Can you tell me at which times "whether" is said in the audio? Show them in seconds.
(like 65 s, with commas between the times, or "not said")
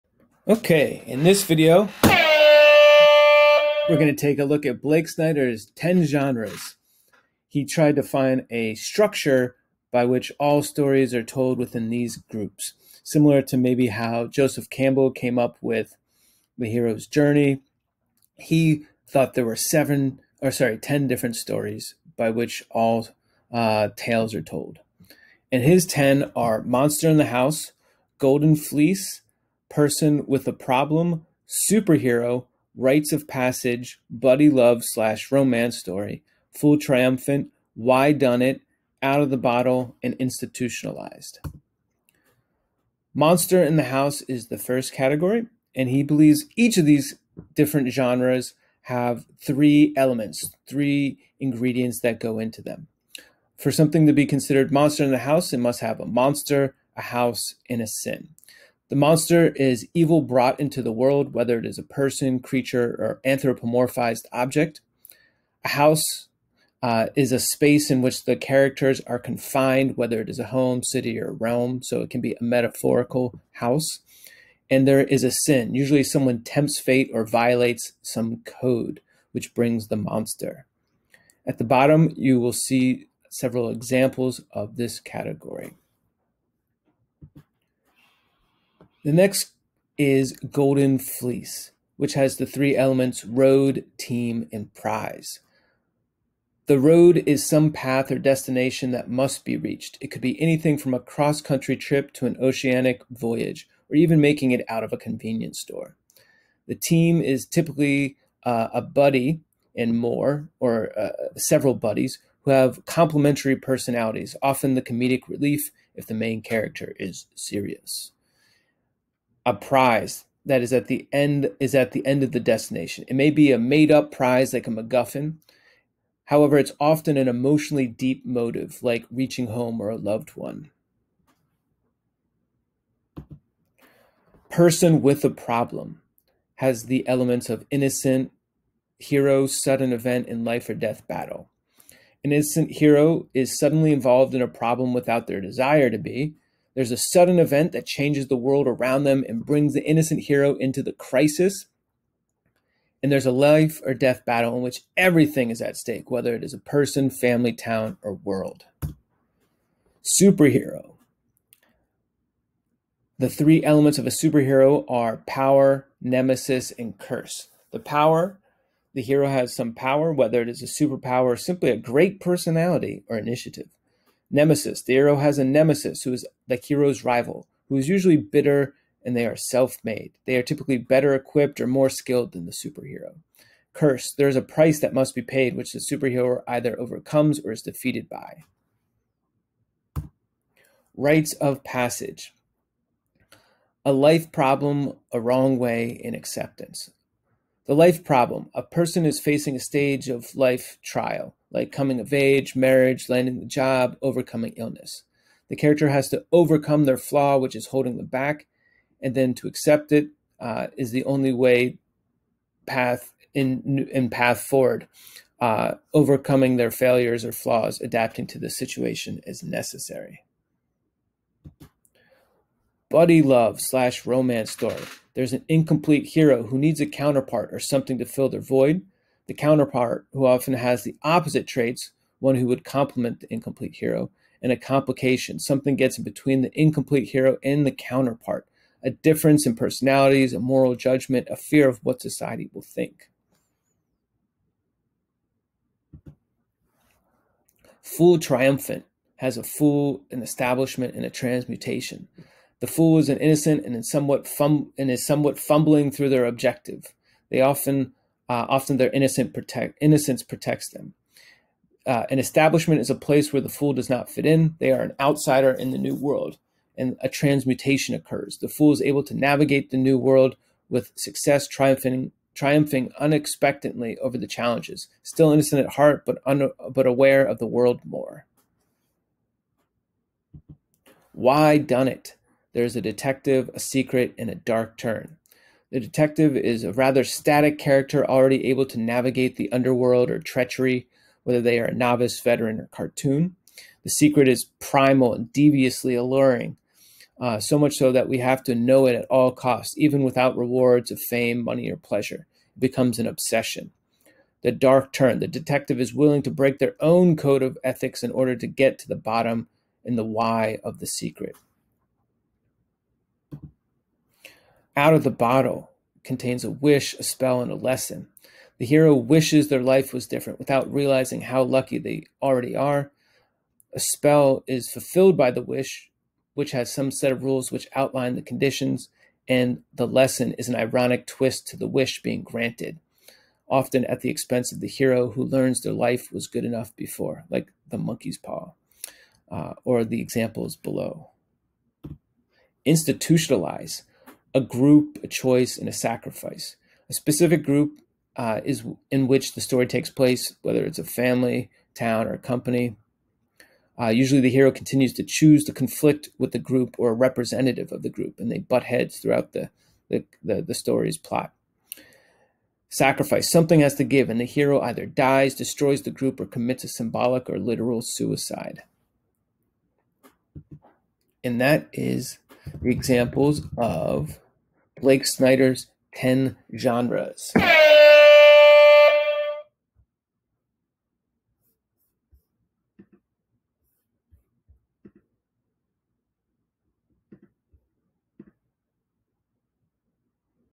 61 s, 69 s, 156 s, 170 s, 291 s, 350 s.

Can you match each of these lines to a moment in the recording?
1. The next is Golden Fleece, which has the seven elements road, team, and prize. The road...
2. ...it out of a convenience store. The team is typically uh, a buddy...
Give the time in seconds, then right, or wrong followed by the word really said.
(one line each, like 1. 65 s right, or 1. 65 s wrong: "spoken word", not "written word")
1. 89 s wrong: "three", not "seven"
2. 104 s right.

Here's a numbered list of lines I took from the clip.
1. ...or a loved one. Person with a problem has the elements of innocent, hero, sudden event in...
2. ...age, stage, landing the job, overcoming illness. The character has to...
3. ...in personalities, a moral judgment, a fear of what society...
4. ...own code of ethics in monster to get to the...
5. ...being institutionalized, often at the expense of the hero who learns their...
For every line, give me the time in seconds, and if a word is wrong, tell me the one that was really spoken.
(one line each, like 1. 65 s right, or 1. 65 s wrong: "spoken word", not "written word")
1. 129 s right
2. 202 s wrong: "marriage", not "stage"
3. 239 s right
4. 306 s wrong: "order", not "monster"
5. 332 s wrong: "granted", not "institutionalized".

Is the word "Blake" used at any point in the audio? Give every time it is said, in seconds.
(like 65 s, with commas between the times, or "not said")
4 s, 374 s.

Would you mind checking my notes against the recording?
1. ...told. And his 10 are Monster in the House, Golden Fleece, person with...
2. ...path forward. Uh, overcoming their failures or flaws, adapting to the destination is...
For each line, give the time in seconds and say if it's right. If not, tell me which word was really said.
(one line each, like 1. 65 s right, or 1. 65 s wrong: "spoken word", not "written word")
1. 24 s right
2. 214 s wrong: "situation", not "destination".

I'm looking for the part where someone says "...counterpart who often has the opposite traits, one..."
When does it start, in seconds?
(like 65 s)
229 s.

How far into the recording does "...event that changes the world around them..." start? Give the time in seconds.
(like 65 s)
147 s.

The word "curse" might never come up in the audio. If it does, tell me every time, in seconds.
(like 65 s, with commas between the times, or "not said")
166 s, 183 s.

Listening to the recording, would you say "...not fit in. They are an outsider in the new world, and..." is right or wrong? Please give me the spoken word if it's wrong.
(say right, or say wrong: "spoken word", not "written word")
right.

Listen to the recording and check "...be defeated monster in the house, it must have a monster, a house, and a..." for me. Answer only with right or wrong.
wrong.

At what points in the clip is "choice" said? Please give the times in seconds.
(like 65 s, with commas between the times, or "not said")
345 s.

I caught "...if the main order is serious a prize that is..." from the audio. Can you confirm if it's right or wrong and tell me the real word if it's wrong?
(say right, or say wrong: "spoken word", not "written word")
wrong: "character", not "order".